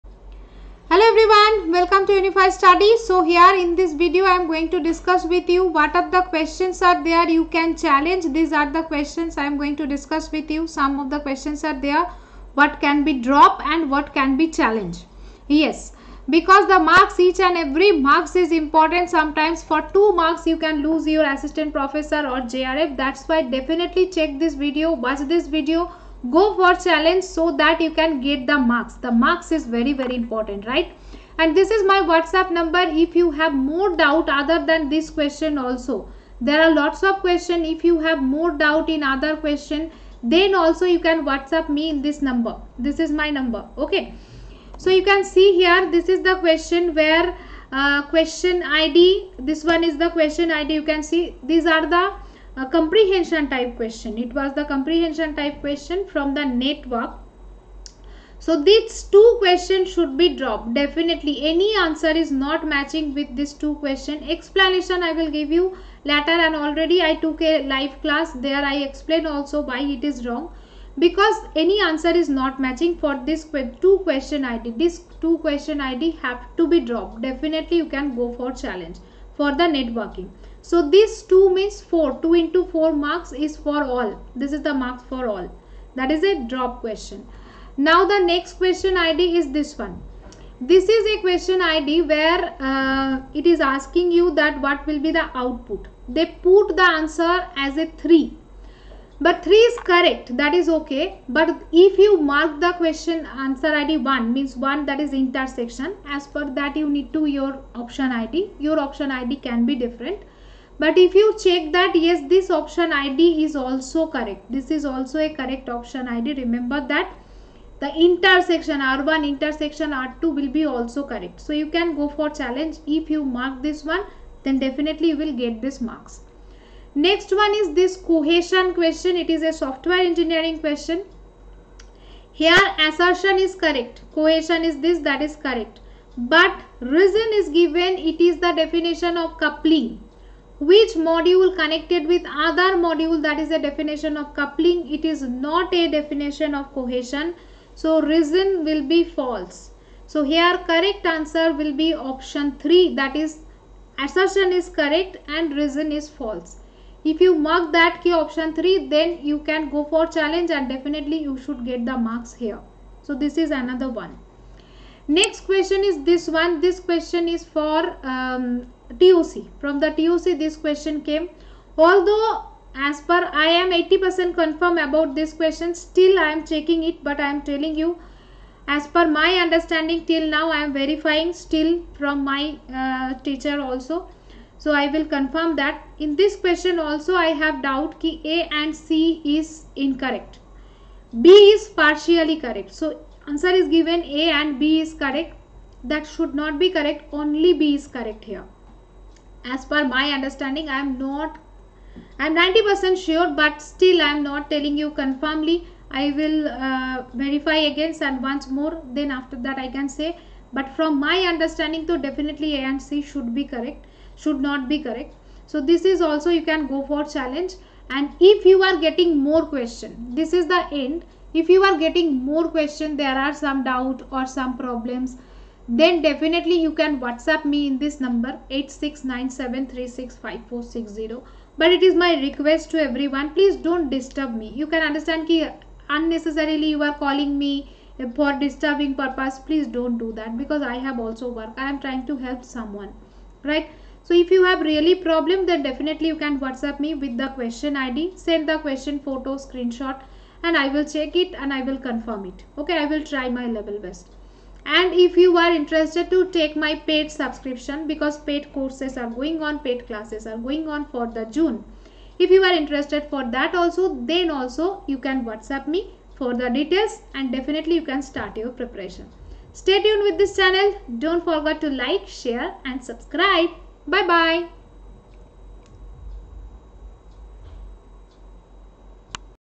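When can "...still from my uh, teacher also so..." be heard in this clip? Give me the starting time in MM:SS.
03:01.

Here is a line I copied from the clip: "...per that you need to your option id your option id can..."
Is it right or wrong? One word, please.
right.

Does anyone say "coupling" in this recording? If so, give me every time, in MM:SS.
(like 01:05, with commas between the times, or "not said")
02:19, 02:24.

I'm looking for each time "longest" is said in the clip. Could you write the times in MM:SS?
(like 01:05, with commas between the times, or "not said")
not said.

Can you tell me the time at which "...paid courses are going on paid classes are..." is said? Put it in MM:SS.
04:18.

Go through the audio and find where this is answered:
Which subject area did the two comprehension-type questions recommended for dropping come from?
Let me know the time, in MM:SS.
00:56.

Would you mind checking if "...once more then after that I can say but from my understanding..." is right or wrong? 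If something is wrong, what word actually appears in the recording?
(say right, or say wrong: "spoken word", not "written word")
right.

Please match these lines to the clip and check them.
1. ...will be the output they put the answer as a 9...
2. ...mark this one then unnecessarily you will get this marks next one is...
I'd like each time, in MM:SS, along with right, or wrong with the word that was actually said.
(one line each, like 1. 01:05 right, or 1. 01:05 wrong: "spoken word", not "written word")
1. 01:34 wrong: "3", not "9"
2. 02:03 wrong: "definitely", not "unnecessarily".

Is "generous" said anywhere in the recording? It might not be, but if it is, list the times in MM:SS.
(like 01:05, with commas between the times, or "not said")
not said.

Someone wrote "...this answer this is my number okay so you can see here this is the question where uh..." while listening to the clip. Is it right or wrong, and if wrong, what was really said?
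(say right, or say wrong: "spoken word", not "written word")
wrong: "number", not "answer".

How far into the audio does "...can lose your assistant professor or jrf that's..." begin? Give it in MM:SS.
00:20.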